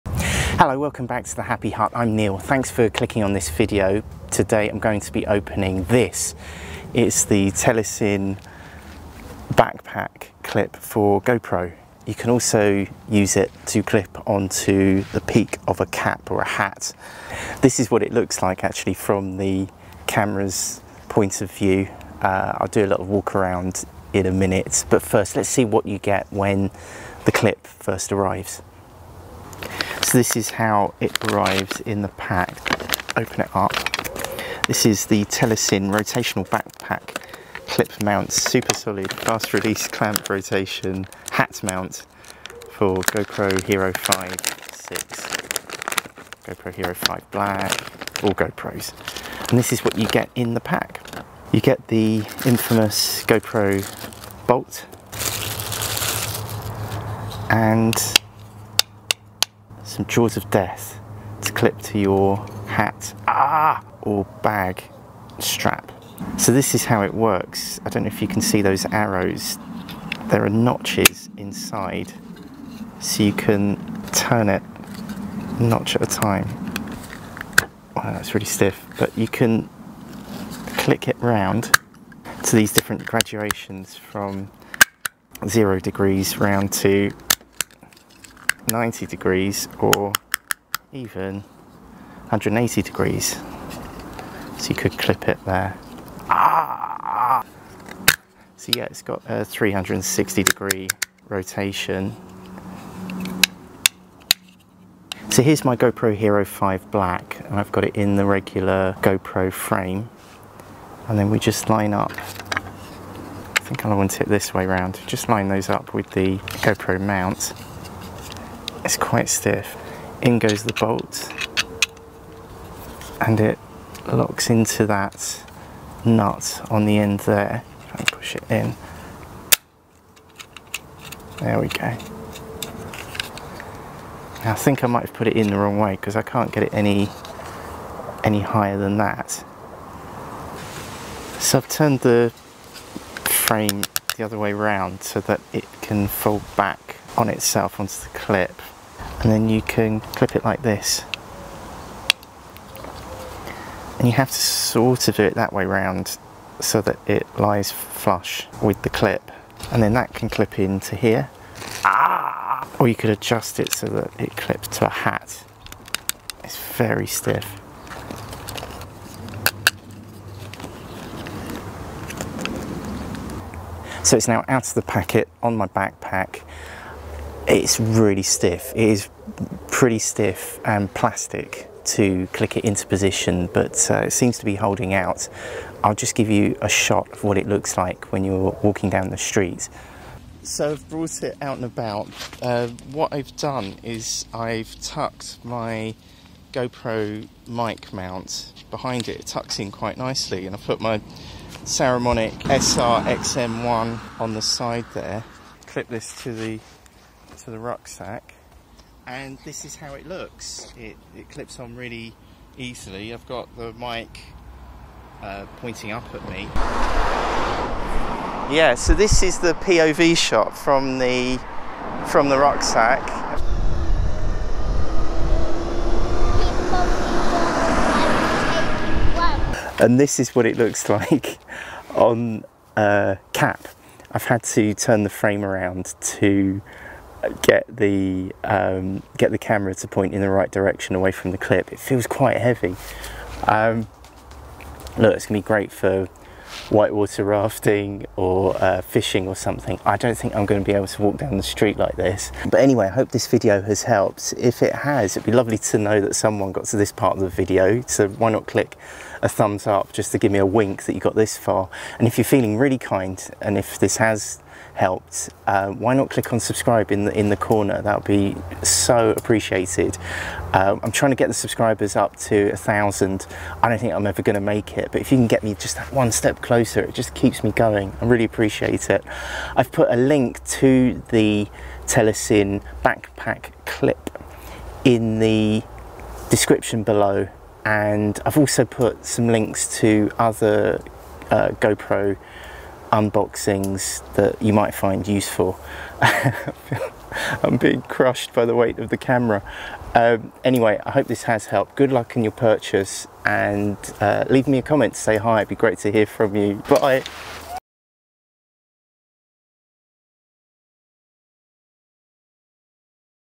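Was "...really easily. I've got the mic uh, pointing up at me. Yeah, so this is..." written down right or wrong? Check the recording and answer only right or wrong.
right.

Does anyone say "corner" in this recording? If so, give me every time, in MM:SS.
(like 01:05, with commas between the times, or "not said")
04:27.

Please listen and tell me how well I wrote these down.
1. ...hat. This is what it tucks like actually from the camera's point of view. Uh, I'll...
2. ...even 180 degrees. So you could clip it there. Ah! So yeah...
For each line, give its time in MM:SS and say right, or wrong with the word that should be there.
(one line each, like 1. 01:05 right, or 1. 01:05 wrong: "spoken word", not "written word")
1. 00:16 wrong: "looks", not "tucks"
2. 01:30 right.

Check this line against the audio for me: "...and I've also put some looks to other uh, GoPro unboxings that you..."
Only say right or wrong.
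wrong.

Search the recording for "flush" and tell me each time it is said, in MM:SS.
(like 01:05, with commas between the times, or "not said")
02:37.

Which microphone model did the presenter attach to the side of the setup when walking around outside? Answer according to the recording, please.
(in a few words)
Saramonic SR XM1.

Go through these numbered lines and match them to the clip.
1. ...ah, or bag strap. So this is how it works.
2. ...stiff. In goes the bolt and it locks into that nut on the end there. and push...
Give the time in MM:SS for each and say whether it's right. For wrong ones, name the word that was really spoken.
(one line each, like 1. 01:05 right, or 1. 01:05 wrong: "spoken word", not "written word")
1. 01:03 right
2. 01:59 right.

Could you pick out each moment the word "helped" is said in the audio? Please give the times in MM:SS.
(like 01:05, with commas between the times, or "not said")
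04:13, 04:24, 05:01.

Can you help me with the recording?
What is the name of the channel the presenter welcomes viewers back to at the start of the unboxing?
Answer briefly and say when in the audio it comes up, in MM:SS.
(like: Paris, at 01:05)
Happy Hut, at 00:01.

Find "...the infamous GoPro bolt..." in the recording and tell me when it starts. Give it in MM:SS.
00:51.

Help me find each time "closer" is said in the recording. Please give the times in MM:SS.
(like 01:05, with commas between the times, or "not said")
04:36.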